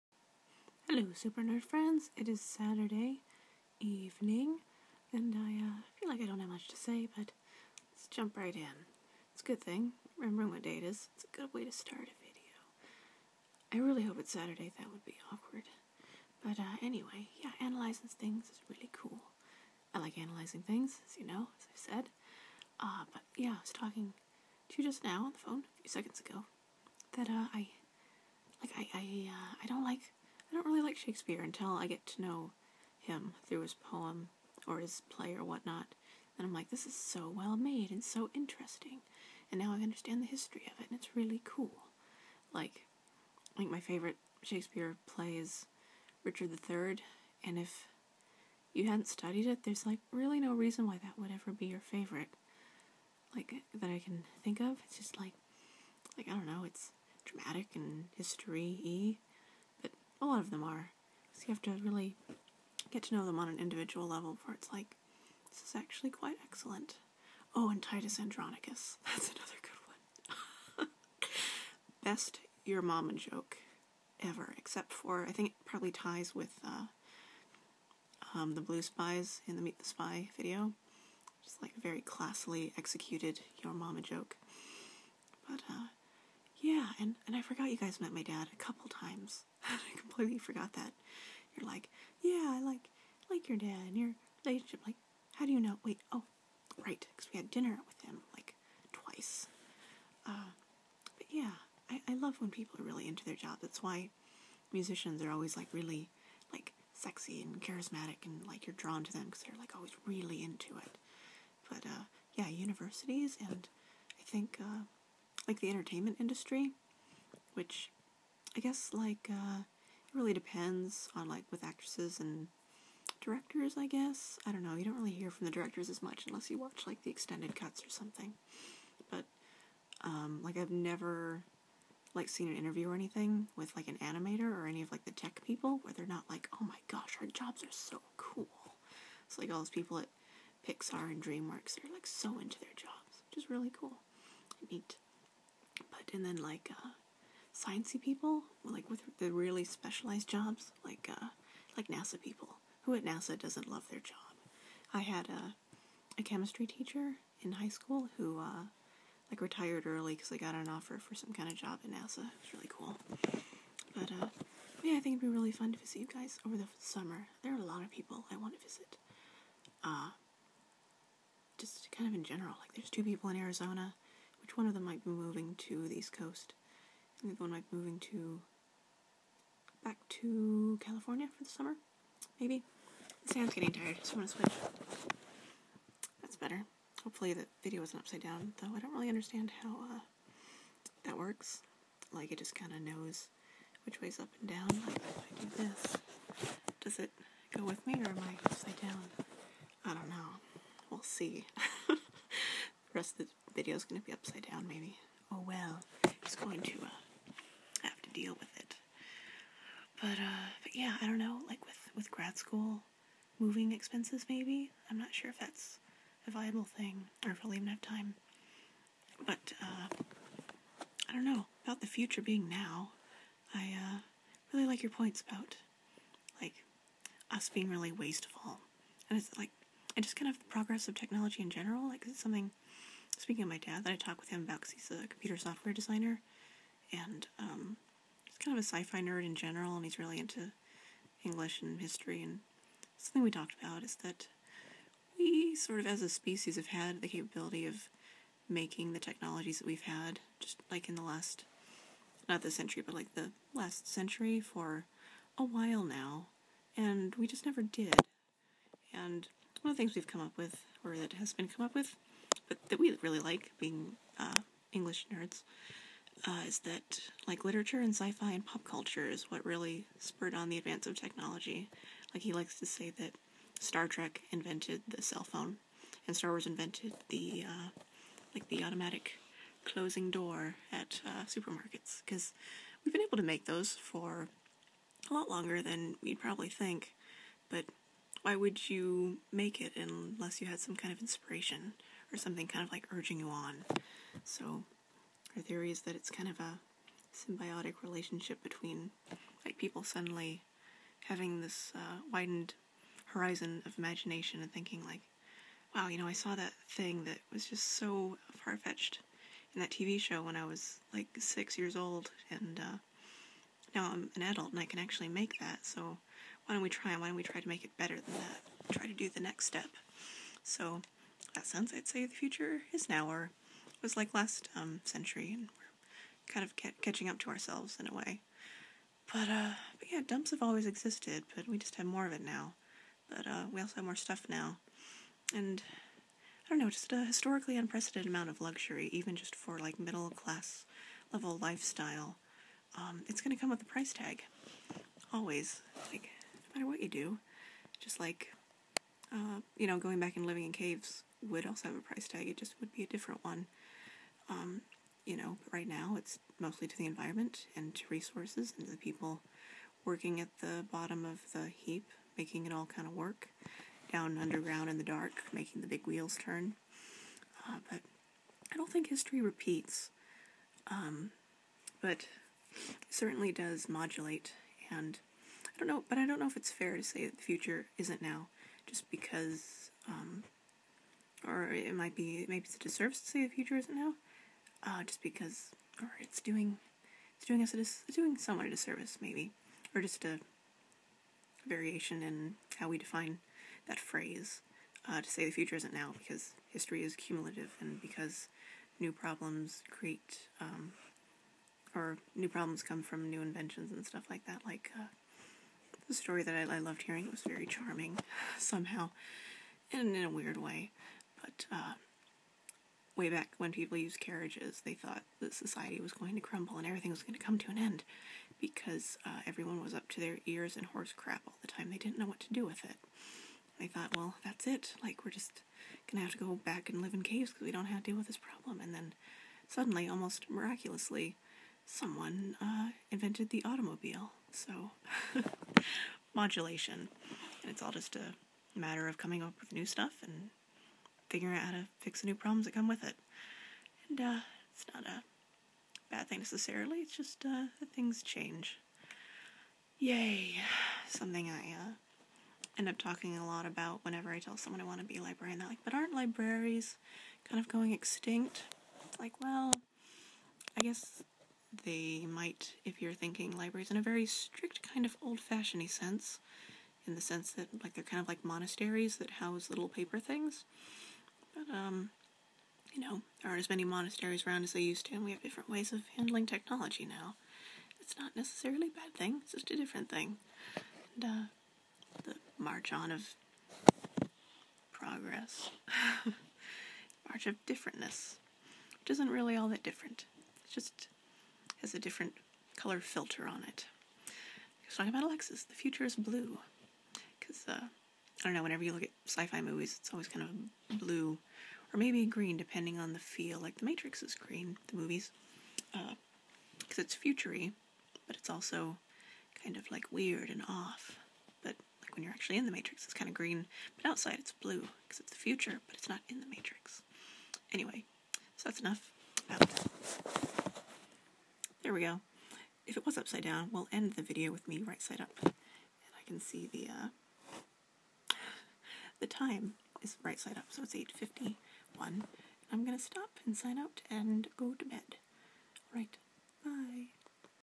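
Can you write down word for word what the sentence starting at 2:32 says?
Who at NASA doesn't love their job?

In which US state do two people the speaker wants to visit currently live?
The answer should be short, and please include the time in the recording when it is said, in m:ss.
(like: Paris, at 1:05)
Arizona, at 2:53.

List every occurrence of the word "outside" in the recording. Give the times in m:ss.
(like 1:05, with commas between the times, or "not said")
8:33.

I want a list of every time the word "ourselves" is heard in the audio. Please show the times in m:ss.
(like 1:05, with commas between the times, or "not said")
5:27.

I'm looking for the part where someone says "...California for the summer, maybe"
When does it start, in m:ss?
3:00.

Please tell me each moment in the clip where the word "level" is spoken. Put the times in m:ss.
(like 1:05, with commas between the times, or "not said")
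1:04, 5:41.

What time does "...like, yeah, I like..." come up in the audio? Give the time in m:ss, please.
1:31.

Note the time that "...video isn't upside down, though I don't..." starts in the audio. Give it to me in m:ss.
3:07.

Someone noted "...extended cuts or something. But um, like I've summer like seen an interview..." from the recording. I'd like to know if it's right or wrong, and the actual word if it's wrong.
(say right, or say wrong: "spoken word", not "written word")
wrong: "never", not "summer".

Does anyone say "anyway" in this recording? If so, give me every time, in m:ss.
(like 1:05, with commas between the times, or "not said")
0:16, 8:37.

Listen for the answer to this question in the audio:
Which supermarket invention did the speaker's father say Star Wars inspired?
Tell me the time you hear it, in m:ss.
4:38.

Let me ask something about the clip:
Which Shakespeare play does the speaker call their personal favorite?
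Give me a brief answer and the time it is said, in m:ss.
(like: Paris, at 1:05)
Richard III, at 0:46.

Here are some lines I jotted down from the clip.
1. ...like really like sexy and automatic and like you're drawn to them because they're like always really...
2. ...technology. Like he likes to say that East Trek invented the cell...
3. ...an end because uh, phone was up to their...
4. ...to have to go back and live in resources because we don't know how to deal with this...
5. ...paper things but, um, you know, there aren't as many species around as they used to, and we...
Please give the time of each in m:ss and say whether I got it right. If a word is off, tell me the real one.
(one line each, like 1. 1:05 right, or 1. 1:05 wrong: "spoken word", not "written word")
1. 1:45 wrong: "charismatic", not "automatic"
2. 4:30 wrong: "Star", not "East"
3. 6:57 wrong: "everyone", not "phone"
4. 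7:06 wrong: "caves", not "resources"
5. 7:49 wrong: "monasteries", not "species".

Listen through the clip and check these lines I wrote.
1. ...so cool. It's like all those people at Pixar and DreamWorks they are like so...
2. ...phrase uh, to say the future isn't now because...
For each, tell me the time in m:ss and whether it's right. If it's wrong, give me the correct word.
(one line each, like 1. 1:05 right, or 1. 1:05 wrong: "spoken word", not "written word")
1. 2:17 right
2. 6:33 right.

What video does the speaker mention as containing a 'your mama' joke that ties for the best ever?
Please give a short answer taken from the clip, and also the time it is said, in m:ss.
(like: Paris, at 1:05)
Meet the Spy, at 1:19.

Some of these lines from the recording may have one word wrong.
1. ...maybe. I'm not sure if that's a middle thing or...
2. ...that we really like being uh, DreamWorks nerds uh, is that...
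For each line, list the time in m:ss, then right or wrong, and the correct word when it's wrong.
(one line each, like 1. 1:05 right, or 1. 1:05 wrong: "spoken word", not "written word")
1. 3:34 wrong: "viable", not "middle"
2. 4:22 wrong: "English", not "DreamWorks".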